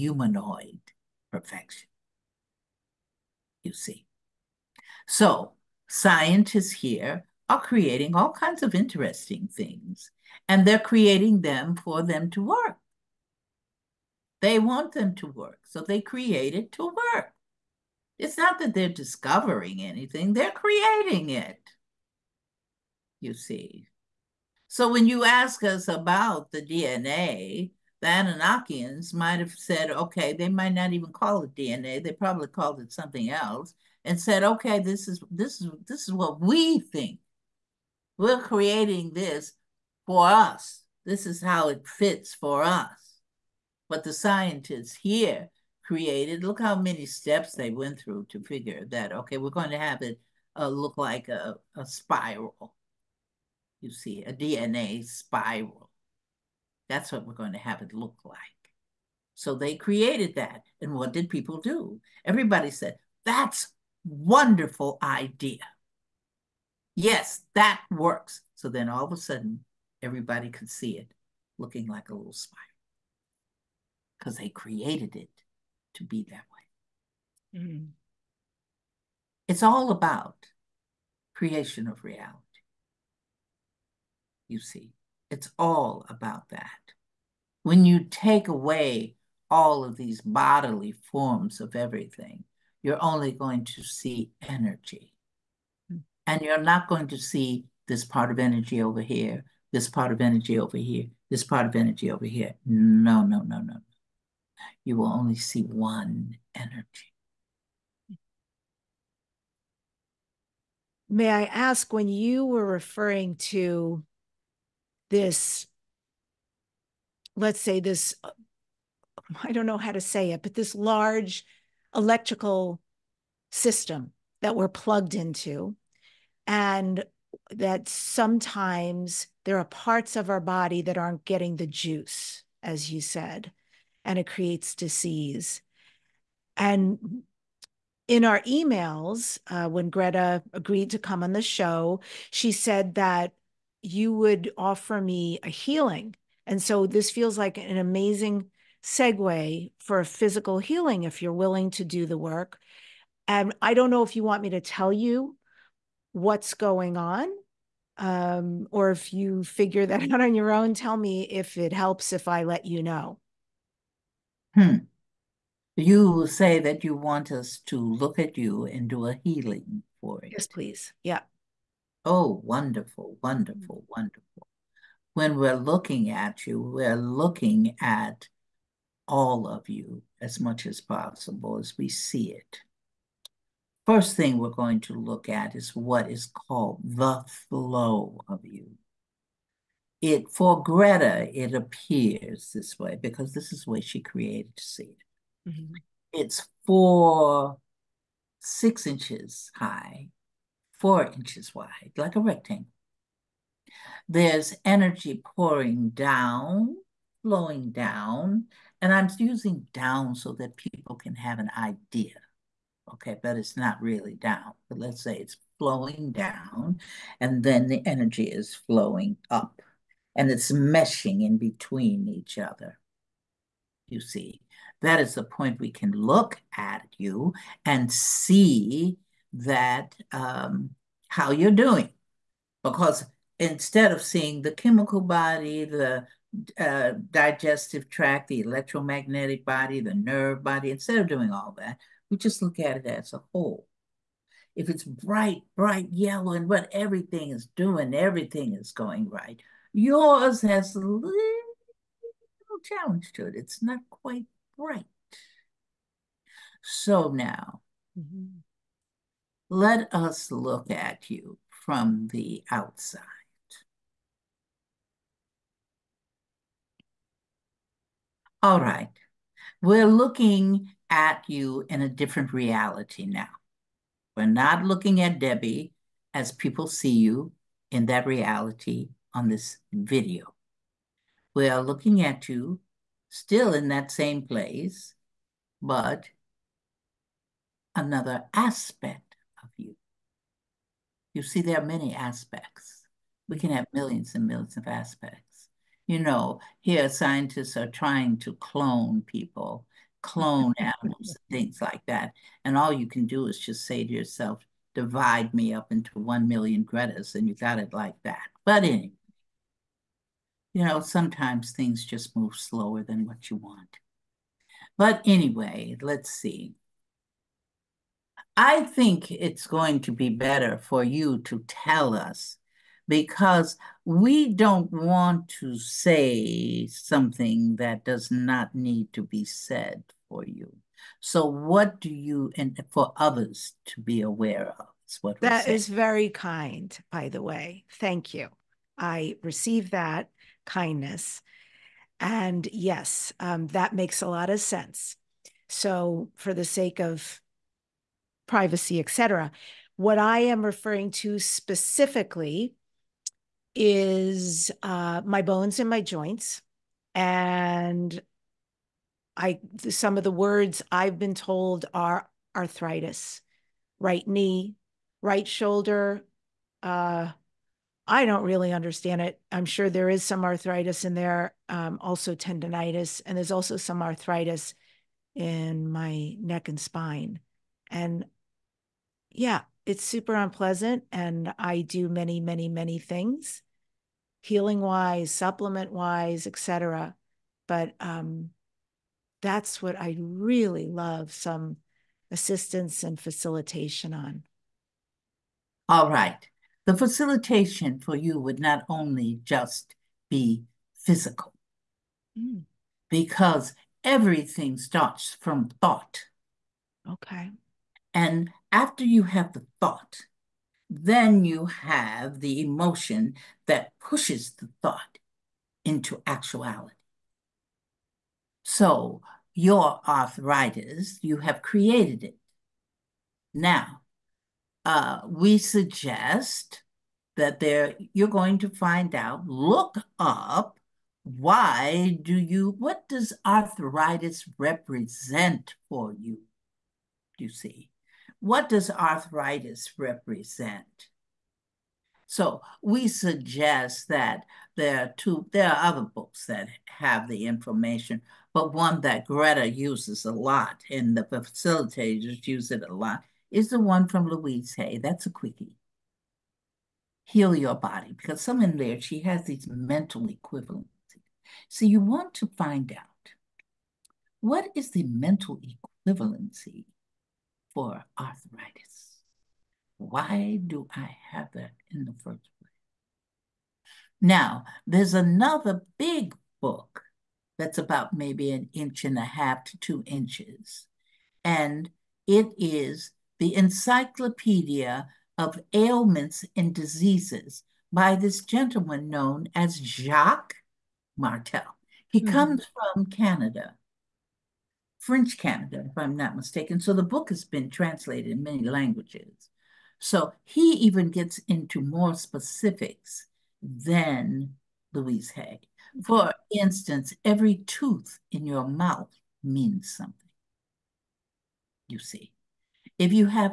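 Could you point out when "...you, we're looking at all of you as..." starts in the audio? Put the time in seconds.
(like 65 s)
176 s.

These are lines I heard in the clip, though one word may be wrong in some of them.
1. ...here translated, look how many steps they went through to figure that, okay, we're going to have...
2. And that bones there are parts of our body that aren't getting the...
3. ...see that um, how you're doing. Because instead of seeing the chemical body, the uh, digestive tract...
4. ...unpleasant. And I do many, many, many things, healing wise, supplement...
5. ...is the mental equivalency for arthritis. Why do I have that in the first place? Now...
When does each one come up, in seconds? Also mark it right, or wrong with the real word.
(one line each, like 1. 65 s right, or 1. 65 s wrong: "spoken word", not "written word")
1. 44 s wrong: "created", not "translated"
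2. 126 s wrong: "sometimes", not "bones"
3. 227 s right
4. 380 s right
5. 464 s right.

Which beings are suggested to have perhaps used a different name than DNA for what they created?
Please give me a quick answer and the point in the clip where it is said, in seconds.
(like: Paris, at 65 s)
Anunnakians, at 28 s.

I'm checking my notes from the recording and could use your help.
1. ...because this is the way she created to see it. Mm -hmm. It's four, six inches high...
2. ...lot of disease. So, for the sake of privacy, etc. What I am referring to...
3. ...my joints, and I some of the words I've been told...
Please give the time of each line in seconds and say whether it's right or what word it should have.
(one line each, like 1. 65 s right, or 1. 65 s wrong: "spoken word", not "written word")
1. 193 s right
2. 344 s wrong: "sense", not "disease"
3. 355 s right.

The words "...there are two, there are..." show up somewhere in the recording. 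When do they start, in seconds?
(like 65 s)
444 s.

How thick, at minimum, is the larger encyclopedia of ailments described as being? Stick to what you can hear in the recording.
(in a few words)
An inch and a half.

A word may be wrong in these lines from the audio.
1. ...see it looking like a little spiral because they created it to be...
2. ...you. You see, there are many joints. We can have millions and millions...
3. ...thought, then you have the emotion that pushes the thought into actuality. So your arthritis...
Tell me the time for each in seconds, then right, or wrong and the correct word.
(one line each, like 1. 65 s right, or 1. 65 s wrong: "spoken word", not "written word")
1. 70 s right
2. 289 s wrong: "aspects", not "joints"
3. 409 s right.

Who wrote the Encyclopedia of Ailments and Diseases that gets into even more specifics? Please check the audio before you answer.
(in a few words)
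Jacques Martel.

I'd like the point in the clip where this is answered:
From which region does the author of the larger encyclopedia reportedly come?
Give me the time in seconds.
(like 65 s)
494 s.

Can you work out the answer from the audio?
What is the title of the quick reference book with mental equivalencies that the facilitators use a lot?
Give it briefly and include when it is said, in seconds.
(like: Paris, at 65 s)
Heal Your Body, at 457 s.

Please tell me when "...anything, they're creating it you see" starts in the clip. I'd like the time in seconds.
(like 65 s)
19 s.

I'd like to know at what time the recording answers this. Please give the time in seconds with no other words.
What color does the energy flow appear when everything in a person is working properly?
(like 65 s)
245 s.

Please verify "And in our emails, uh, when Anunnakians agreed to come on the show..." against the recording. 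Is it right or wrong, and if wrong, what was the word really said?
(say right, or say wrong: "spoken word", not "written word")
wrong: "Gretta", not "Anunnakians".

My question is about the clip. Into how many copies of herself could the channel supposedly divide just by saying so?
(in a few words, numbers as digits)
1 million.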